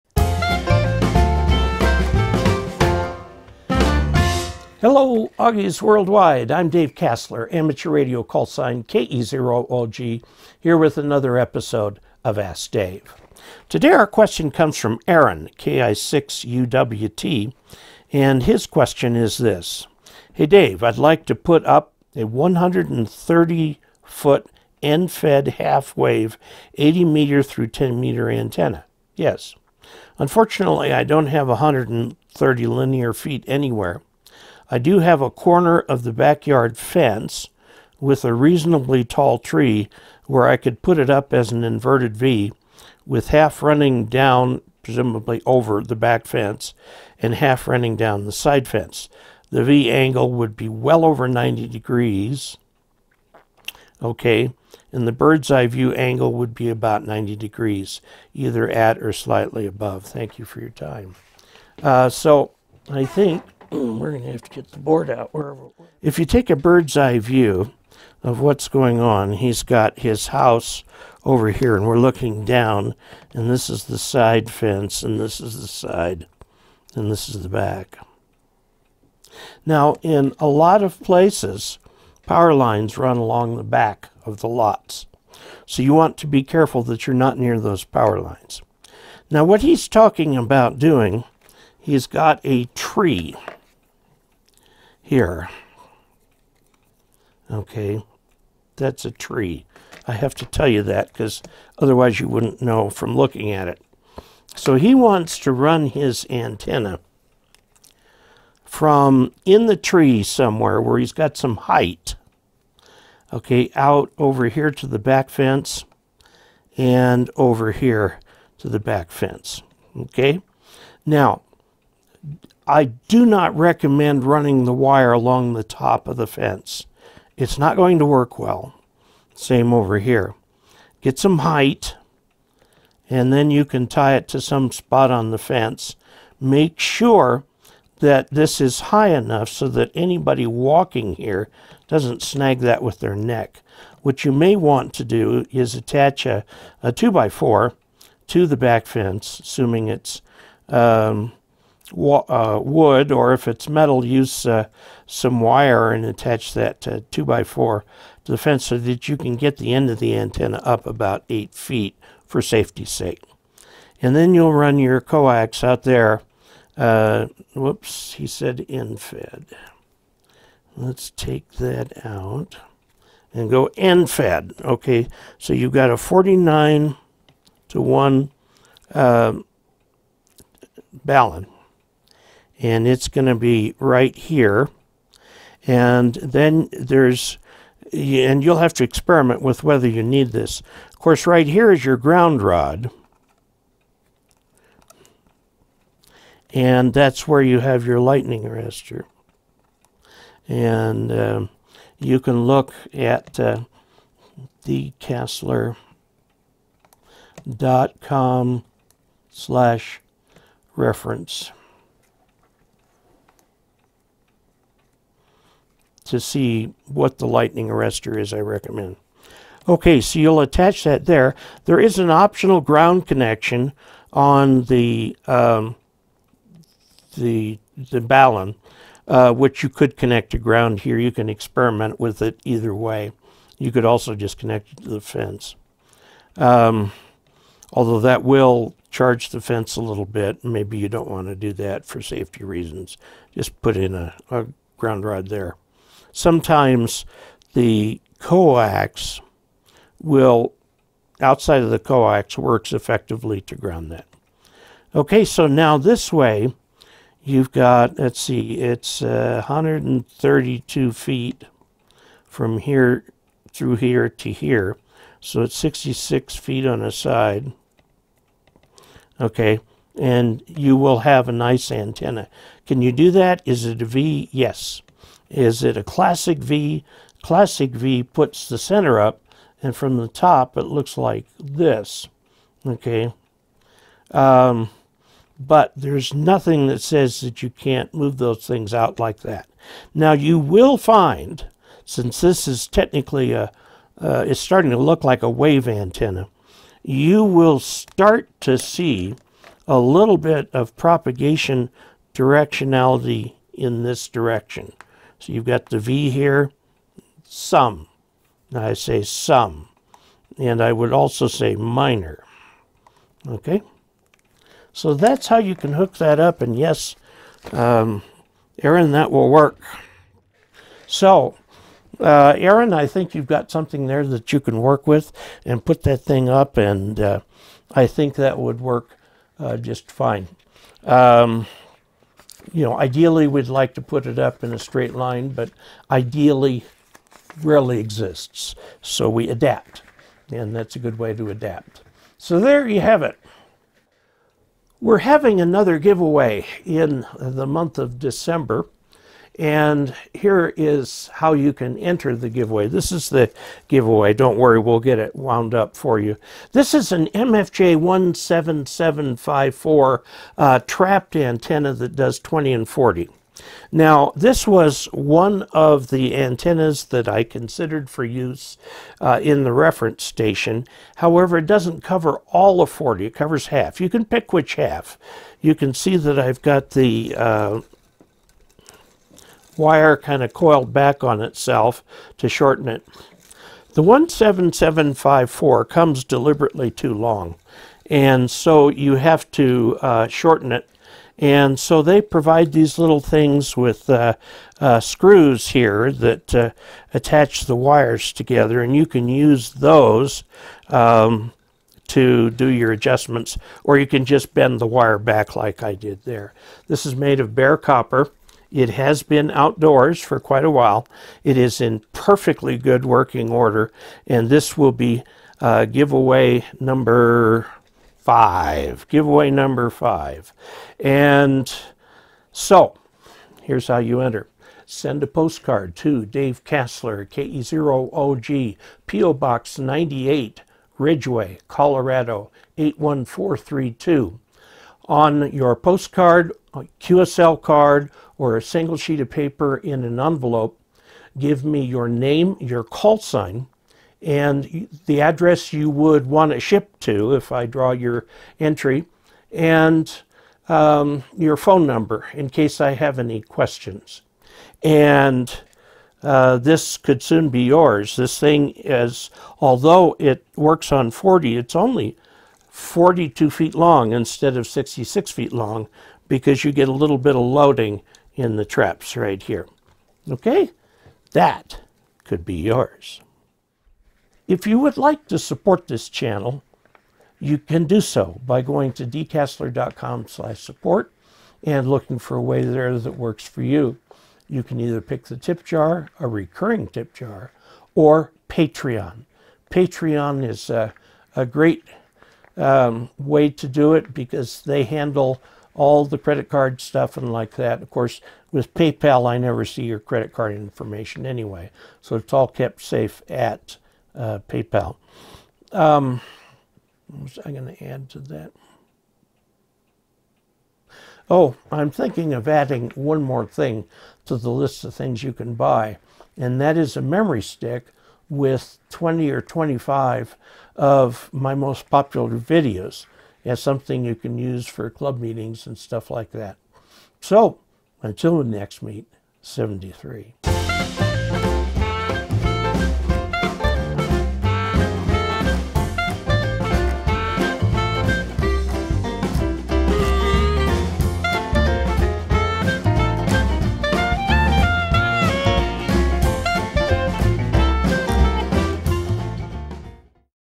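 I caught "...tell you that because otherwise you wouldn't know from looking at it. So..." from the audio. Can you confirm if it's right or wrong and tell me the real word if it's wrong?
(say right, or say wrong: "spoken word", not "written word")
right.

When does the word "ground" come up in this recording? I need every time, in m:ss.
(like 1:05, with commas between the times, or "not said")
3:11, 3:42, 3:50, 4:04, 4:13.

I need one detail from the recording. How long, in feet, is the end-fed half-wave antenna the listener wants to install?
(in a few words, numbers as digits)
130 feet.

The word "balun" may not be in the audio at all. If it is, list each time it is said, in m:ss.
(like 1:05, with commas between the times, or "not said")
3:48.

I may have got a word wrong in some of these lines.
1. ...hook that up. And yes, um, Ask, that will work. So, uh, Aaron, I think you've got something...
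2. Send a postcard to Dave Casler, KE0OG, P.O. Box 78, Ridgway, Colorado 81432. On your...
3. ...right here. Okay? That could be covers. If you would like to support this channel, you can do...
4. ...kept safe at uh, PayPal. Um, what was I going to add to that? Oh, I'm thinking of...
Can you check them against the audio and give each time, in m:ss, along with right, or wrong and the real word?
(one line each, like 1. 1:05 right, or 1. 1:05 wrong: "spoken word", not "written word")
1. 5:15 wrong: "Aaron", not "Ask"
2. 7:04 wrong: "98", not "78"
3. 7:48 wrong: "yours", not "covers"
4. 8:22 right.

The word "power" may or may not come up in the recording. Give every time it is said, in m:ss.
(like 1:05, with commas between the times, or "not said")
1:22, 1:27.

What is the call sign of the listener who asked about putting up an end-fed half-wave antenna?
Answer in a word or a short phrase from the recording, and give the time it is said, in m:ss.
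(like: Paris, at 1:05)
KI6UWT, at 0:15.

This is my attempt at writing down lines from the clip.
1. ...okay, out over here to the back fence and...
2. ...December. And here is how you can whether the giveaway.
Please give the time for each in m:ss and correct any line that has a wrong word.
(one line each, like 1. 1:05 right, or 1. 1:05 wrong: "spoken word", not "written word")
1. 1:53 right
2. 5:47 wrong: "enter", not "whether".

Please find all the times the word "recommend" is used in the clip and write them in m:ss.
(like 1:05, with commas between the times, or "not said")
2:03, 3:38.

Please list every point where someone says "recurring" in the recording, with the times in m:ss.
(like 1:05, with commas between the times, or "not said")
8:06.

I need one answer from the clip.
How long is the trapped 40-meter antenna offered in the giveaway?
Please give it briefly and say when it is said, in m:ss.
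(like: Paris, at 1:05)
42 feet, at 7:42.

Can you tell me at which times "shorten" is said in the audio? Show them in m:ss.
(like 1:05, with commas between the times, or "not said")
6:22, 6:30.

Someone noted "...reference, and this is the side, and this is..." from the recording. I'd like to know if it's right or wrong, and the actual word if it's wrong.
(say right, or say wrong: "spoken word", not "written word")
wrong: "fence", not "reference".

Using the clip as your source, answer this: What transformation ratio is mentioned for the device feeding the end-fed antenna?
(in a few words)
49 to 1.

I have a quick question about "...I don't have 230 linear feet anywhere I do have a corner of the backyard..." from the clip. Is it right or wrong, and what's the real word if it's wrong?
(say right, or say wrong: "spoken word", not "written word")
wrong: "130", not "230".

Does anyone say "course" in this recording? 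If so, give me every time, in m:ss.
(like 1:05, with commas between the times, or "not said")
3:10, 8:17.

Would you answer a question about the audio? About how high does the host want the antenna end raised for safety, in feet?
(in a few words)
8 feet.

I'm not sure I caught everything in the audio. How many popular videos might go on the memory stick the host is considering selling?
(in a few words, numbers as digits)
20 or 25.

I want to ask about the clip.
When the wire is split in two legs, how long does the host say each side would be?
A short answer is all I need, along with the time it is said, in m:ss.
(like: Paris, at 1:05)
66 feet, at 4:25.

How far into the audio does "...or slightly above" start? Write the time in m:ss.
0:58.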